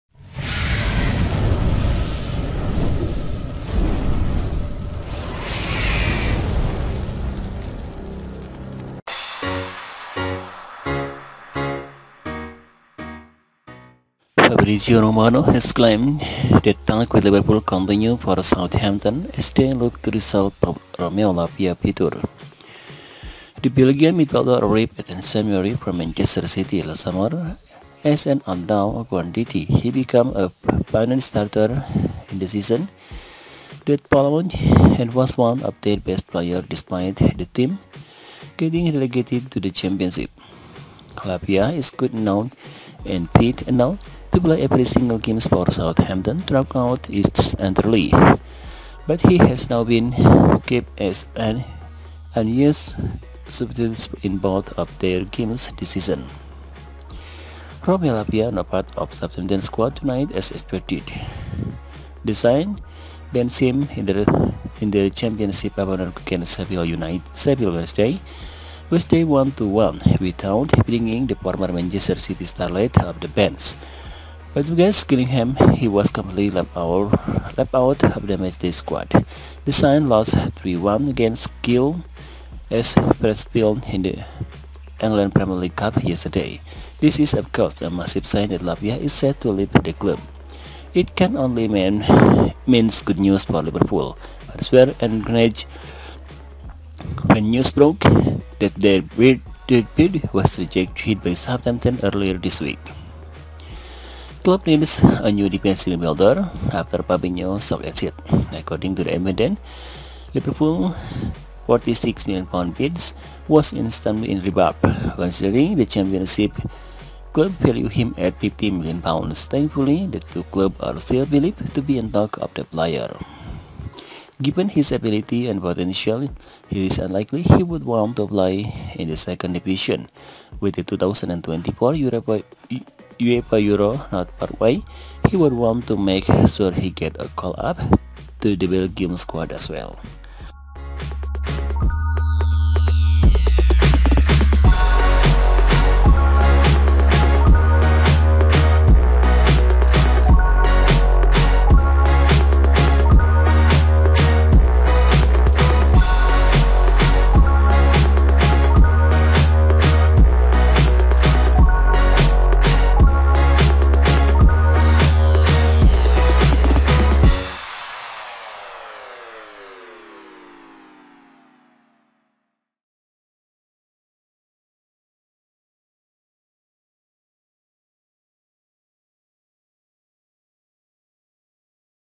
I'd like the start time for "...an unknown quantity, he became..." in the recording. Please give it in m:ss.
0:28.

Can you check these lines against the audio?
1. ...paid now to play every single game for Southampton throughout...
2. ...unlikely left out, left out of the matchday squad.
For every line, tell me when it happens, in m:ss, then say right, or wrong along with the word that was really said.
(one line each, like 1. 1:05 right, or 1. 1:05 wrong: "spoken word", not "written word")
1. 0:43 right
2. 1:16 wrong: "completely", not "unlikely".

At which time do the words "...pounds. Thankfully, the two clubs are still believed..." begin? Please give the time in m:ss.
1:58.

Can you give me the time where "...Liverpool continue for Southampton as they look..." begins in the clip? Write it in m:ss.
0:17.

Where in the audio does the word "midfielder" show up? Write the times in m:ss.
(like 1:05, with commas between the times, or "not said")
0:24, 1:46.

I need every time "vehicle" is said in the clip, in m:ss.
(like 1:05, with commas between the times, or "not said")
not said.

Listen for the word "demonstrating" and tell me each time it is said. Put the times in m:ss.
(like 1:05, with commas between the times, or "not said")
not said.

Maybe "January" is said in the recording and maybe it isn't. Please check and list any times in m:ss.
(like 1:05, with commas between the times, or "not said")
0:25.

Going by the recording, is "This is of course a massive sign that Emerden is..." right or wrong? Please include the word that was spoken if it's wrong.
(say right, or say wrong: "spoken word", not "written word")
wrong: "Lavia", not "Emerden".